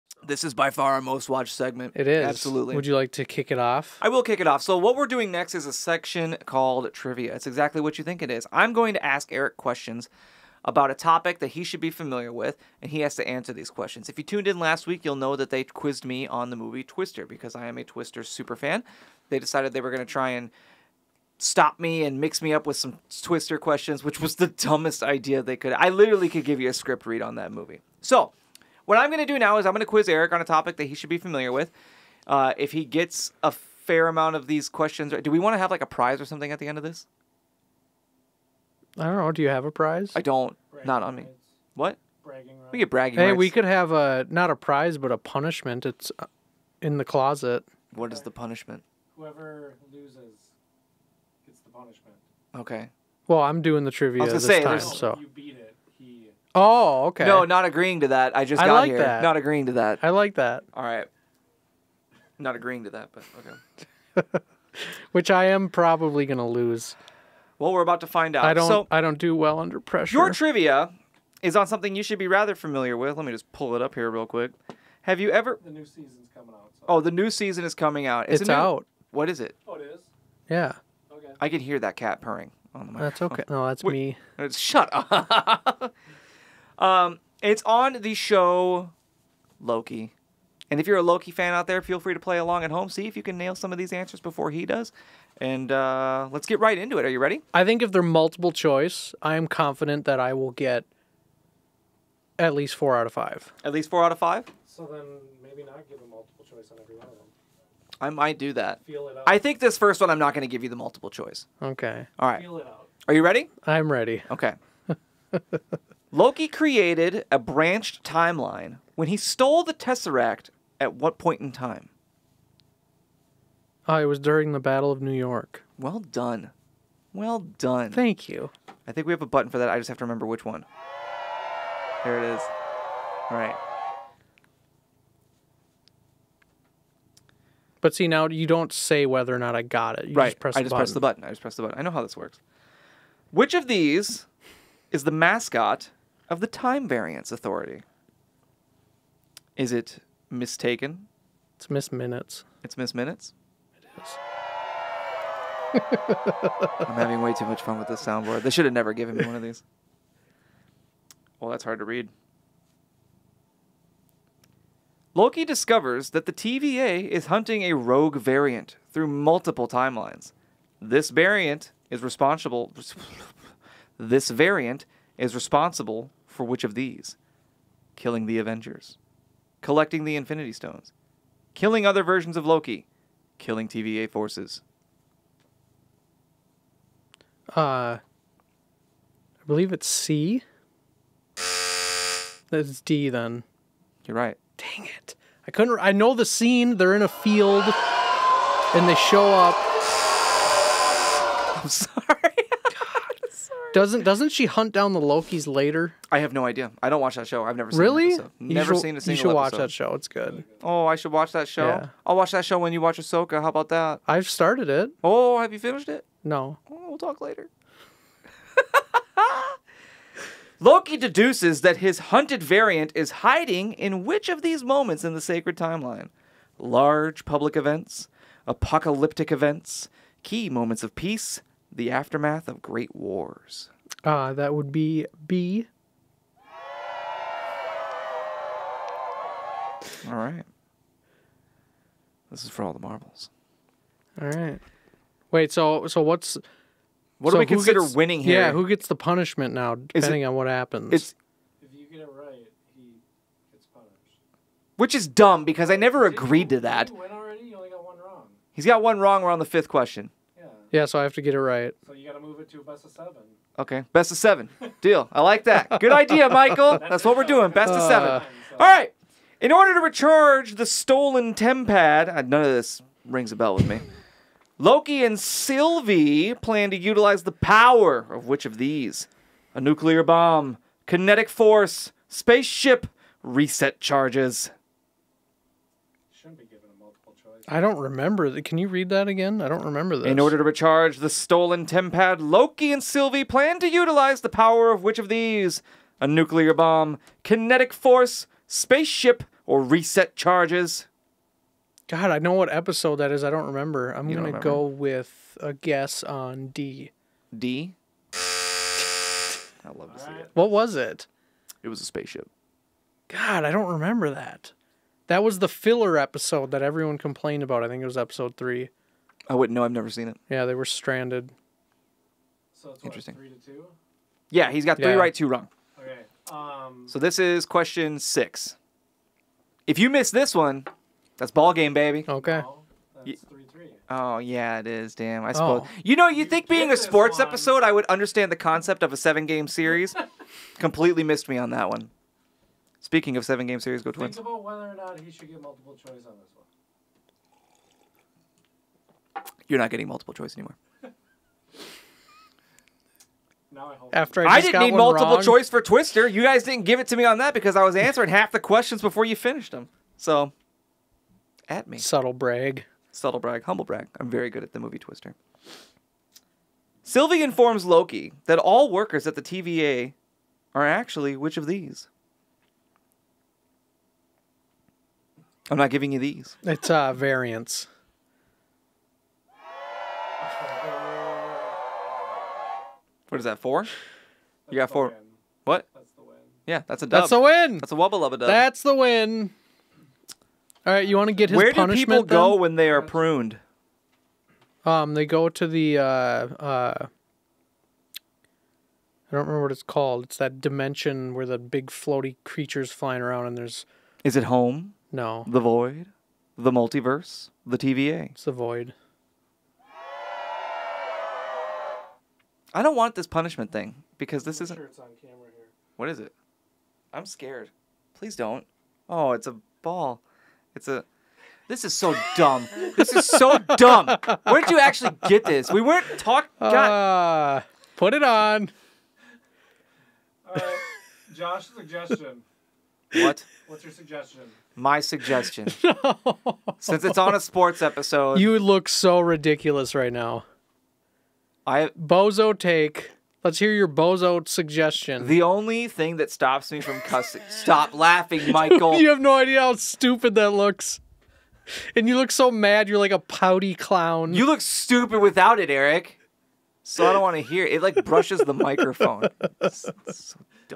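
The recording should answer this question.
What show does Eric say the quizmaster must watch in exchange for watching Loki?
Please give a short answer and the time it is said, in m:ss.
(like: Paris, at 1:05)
Ahsoka, at 3:32.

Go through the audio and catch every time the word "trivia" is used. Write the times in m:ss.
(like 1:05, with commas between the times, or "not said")
0:06, 0:53, 1:10.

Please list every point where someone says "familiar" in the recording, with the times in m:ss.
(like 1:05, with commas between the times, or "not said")
0:11, 0:31, 1:12.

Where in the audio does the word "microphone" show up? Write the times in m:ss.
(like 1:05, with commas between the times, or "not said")
1:22, 7:38.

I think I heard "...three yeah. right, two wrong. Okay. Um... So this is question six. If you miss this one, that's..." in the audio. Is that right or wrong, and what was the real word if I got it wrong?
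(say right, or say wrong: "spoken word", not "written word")
right.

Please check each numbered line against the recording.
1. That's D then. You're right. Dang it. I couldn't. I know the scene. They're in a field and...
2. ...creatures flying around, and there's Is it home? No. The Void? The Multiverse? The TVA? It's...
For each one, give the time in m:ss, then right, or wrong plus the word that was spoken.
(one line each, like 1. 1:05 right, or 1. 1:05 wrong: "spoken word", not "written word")
1. 3:12 right
2. 6:42 right.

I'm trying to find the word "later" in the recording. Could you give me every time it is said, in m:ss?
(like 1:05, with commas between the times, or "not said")
3:25, 3:37.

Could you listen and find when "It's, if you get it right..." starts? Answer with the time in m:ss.
4:10.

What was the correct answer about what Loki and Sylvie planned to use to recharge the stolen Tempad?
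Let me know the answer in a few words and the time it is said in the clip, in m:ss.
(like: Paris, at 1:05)
A spaceship, at 5:11.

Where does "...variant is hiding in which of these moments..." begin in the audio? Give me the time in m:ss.
3:42.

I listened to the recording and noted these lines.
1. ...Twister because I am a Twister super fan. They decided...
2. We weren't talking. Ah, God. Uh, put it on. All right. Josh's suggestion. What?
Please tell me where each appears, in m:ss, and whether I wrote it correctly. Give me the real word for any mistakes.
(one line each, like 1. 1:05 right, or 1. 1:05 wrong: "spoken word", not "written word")
1. 0:16 right
2. 7:05 right.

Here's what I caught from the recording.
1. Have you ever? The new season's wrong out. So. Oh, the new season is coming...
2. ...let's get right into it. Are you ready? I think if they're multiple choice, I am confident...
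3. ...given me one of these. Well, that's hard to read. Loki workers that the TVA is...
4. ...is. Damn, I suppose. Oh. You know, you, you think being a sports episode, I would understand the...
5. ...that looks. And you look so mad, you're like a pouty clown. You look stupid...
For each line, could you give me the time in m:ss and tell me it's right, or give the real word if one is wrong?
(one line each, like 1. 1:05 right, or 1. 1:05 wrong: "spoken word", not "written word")
1. 1:15 wrong: "coming", not "wrong"
2. 1:36 right
3. 2:38 wrong: "discovers", not "workers"
4. 5:34 right
5. 7:30 right.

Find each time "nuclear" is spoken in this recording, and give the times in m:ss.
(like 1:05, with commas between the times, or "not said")
4:39, 4:56.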